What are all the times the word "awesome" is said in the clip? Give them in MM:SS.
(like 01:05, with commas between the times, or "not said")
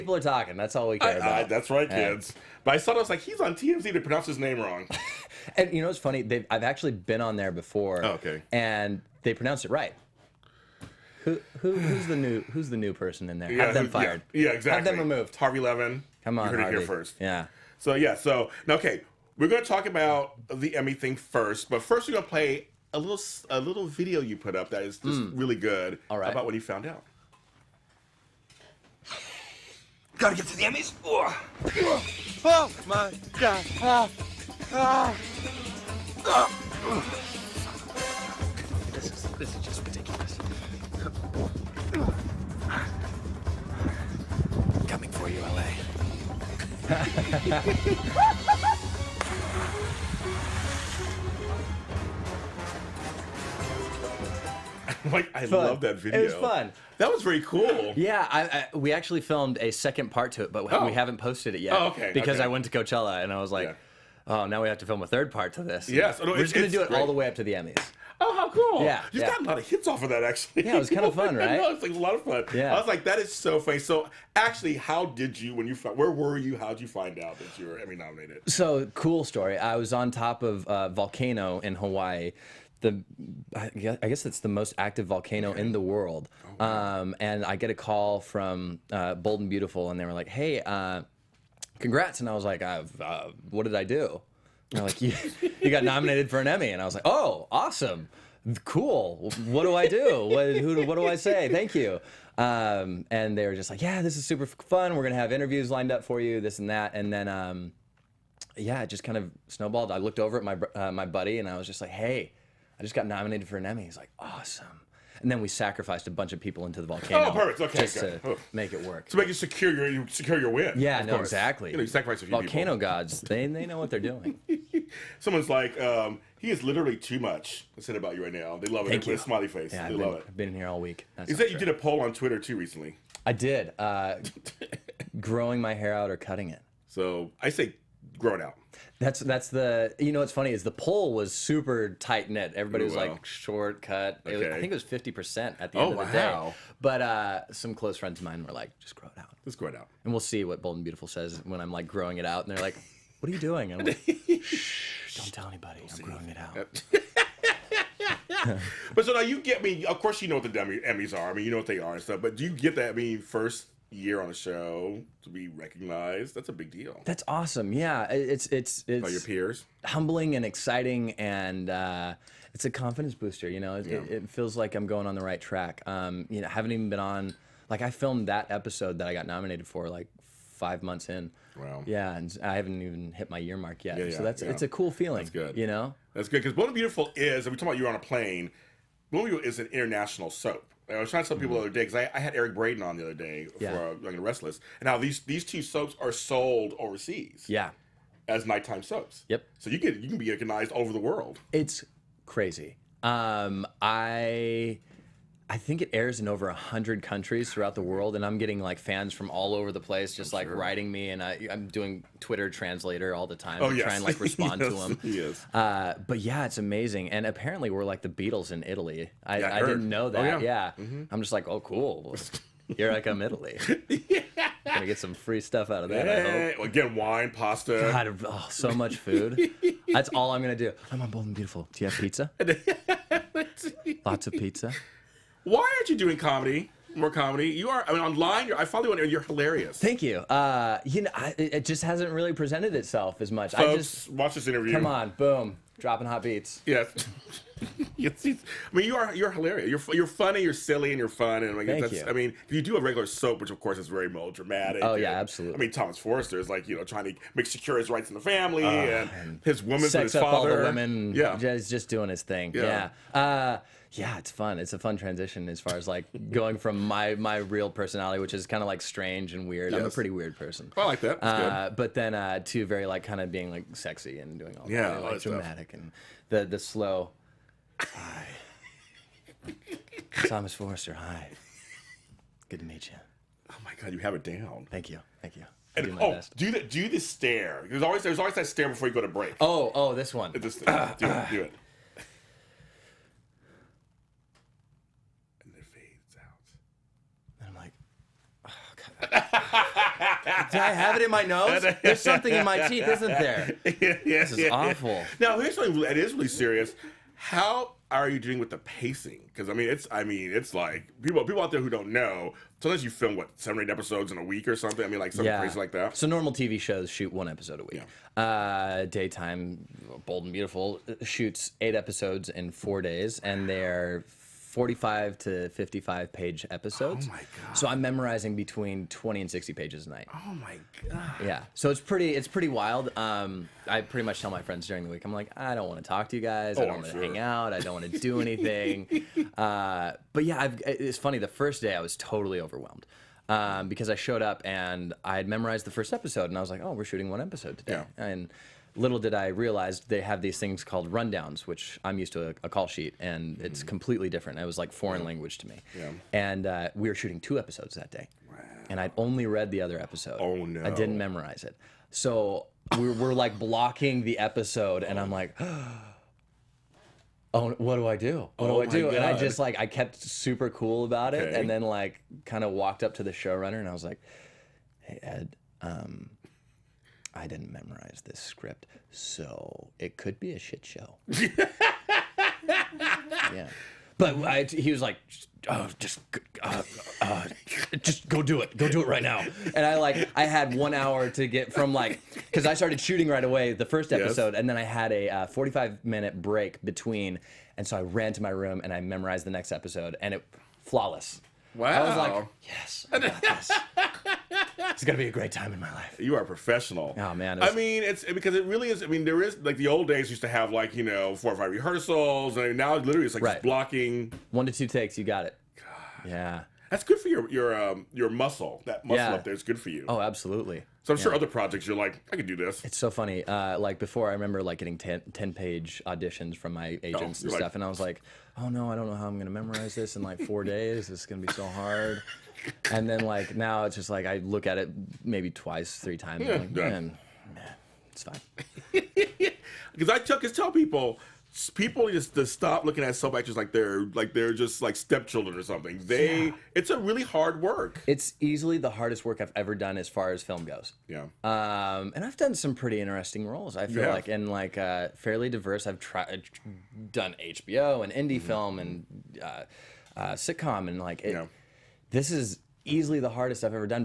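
01:37, 01:54, 02:47.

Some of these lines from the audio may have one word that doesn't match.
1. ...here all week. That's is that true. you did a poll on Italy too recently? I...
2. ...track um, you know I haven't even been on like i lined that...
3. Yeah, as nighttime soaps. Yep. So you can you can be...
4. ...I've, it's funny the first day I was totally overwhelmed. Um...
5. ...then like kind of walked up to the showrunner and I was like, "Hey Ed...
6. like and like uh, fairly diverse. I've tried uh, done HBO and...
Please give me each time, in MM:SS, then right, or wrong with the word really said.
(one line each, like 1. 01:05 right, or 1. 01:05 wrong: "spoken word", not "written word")
1. 02:10 wrong: "Twitter", not "Italy"
2. 02:55 wrong: "filmed", not "lined"
3. 03:17 right
4. 05:40 right
5. 06:11 right
6. 07:33 right.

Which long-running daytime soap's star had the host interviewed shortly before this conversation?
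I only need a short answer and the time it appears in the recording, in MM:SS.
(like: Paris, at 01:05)
Young and Restless, at 03:14.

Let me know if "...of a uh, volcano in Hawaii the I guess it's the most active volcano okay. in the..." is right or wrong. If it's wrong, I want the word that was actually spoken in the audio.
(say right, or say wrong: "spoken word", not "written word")
right.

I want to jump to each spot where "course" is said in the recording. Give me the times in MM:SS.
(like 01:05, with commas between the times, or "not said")
02:01, 02:39, 04:13.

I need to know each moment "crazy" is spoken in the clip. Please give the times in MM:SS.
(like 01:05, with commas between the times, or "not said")
03:22, 05:15.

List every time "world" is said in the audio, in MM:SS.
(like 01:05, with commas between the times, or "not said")
01:25, 03:20, 03:27.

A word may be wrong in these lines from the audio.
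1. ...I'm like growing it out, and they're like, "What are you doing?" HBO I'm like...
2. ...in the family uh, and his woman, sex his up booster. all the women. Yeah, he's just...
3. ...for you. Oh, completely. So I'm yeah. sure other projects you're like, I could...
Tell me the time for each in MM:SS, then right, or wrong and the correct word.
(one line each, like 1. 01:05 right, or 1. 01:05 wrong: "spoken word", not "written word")
1. 02:31 wrong: "And", not "HBO"
2. 04:18 wrong: "father", not "booster"
3. 06:59 wrong: "absolutely", not "completely".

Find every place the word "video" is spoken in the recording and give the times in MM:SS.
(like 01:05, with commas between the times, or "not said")
00:23, 00:55.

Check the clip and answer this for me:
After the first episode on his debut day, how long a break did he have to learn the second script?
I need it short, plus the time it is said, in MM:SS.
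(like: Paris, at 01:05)
45 minutes, at 06:35.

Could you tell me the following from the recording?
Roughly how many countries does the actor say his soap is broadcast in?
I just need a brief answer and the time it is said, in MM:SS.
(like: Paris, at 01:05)
Over 100, at 03:26.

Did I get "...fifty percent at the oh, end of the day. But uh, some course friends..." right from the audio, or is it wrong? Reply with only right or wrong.
wrong.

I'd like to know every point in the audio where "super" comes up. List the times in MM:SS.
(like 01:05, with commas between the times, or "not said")
01:44, 02:21, 06:09.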